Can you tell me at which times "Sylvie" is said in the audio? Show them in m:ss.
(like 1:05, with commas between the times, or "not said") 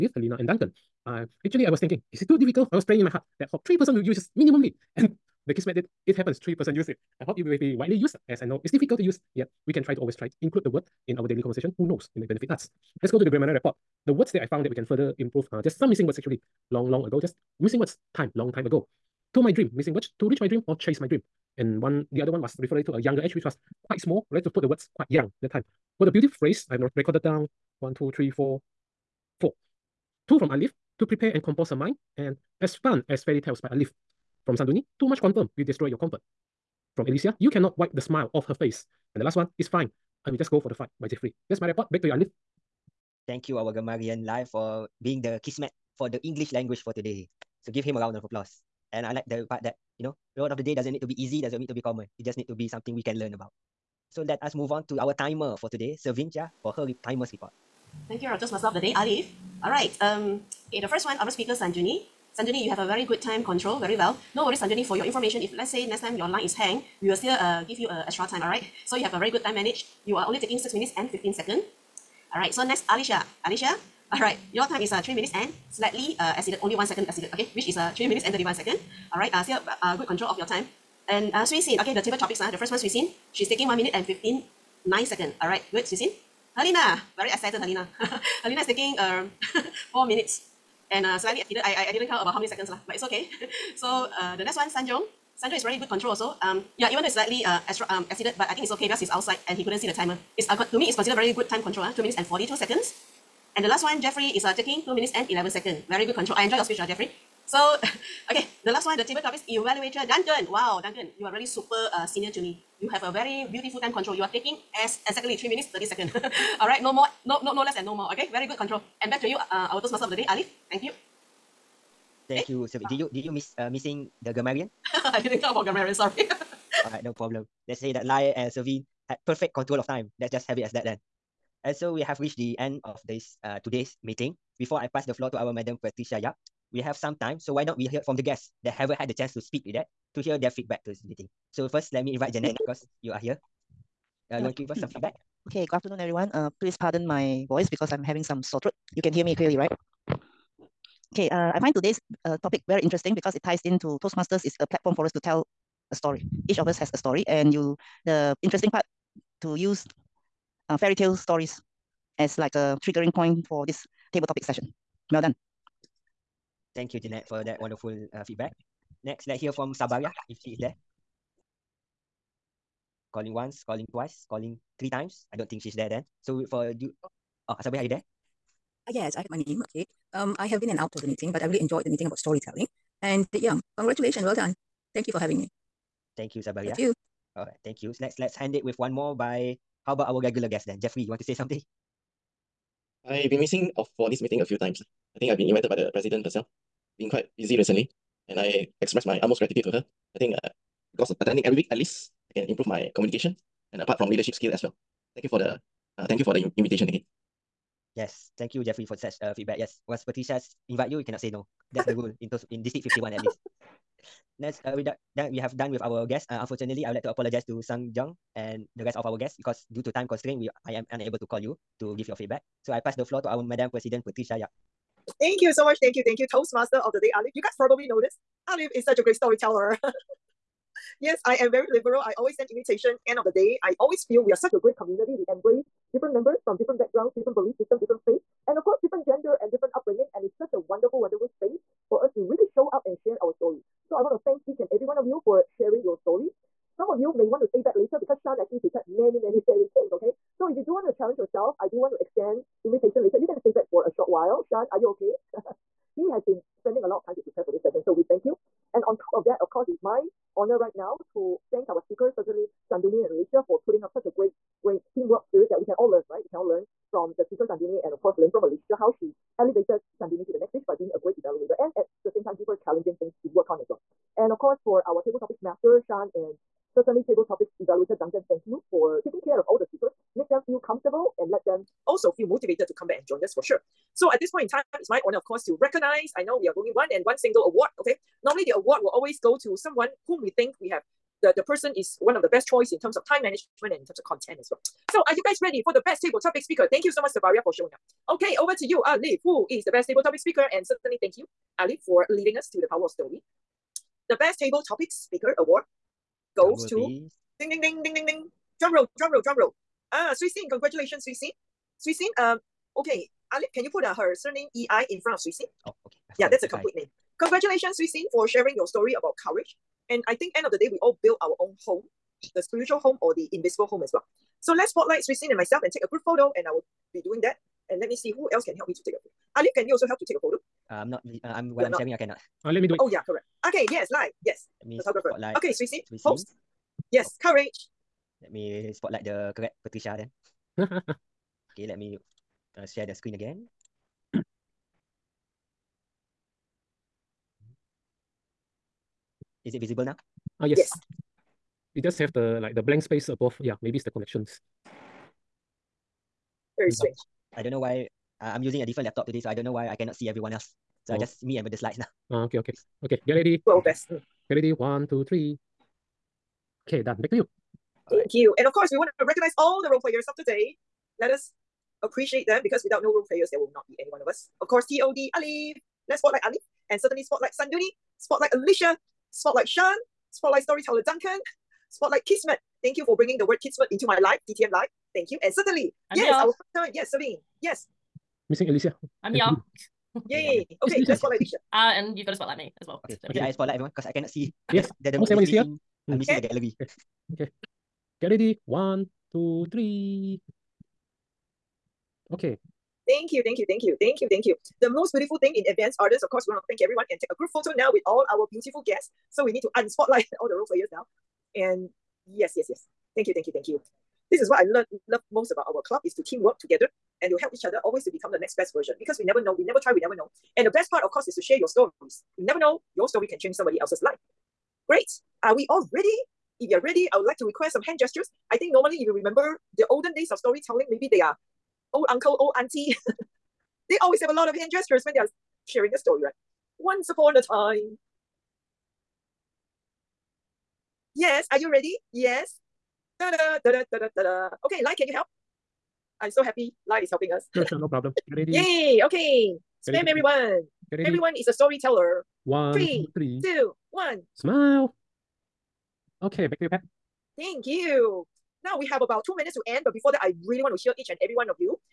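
2:02, 2:08.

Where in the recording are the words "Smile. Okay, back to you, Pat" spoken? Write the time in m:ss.
7:34.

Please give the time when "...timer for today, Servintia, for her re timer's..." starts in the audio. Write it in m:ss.
0:55.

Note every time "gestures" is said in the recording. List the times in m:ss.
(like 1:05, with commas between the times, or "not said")
7:07, 7:14.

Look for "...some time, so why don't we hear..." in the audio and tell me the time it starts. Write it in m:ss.
2:16.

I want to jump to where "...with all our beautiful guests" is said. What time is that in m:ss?
6:47.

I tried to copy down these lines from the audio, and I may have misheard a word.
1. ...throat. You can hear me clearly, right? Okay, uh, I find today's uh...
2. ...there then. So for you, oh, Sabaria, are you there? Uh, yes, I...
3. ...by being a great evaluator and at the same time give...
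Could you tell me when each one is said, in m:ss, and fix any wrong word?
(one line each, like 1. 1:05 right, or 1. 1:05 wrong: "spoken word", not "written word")
1. 2:28 right
2. 2:55 right
3. 4:30 right.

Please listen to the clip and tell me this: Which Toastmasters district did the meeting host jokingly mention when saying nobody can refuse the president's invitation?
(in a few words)
District 51.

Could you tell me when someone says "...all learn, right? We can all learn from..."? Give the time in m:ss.
4:25.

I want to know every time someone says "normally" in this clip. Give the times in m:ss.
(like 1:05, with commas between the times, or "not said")
4:48, 7:08.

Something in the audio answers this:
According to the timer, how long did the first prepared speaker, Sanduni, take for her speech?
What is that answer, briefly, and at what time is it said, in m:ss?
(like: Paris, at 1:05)
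6 minutes 15 seconds, at 1:10.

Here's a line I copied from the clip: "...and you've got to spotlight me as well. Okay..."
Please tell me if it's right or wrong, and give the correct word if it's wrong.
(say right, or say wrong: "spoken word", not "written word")
right.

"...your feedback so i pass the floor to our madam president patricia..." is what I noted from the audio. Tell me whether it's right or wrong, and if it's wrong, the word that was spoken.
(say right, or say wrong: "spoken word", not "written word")
right.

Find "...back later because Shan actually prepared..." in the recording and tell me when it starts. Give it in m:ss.
4:07.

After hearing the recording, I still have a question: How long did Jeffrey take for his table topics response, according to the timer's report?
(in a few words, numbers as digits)
2 minutes 11 seconds.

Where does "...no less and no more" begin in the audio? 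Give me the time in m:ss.
1:57.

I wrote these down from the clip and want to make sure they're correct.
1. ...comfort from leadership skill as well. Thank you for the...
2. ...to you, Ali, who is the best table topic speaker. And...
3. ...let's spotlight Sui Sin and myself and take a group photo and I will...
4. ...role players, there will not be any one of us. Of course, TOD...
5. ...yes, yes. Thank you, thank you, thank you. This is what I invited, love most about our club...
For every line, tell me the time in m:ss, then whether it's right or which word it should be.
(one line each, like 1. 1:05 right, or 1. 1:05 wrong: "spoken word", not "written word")
1. 3:23 wrong: "apart", not "comfort"
2. 4:58 right
3. 5:24 right
4. 6:12 right
5. 6:52 wrong: "learned", not "invited".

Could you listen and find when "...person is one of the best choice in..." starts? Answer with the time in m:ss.
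4:51.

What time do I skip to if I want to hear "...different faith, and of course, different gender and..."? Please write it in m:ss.
3:57.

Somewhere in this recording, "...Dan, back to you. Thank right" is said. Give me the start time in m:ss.
6:06.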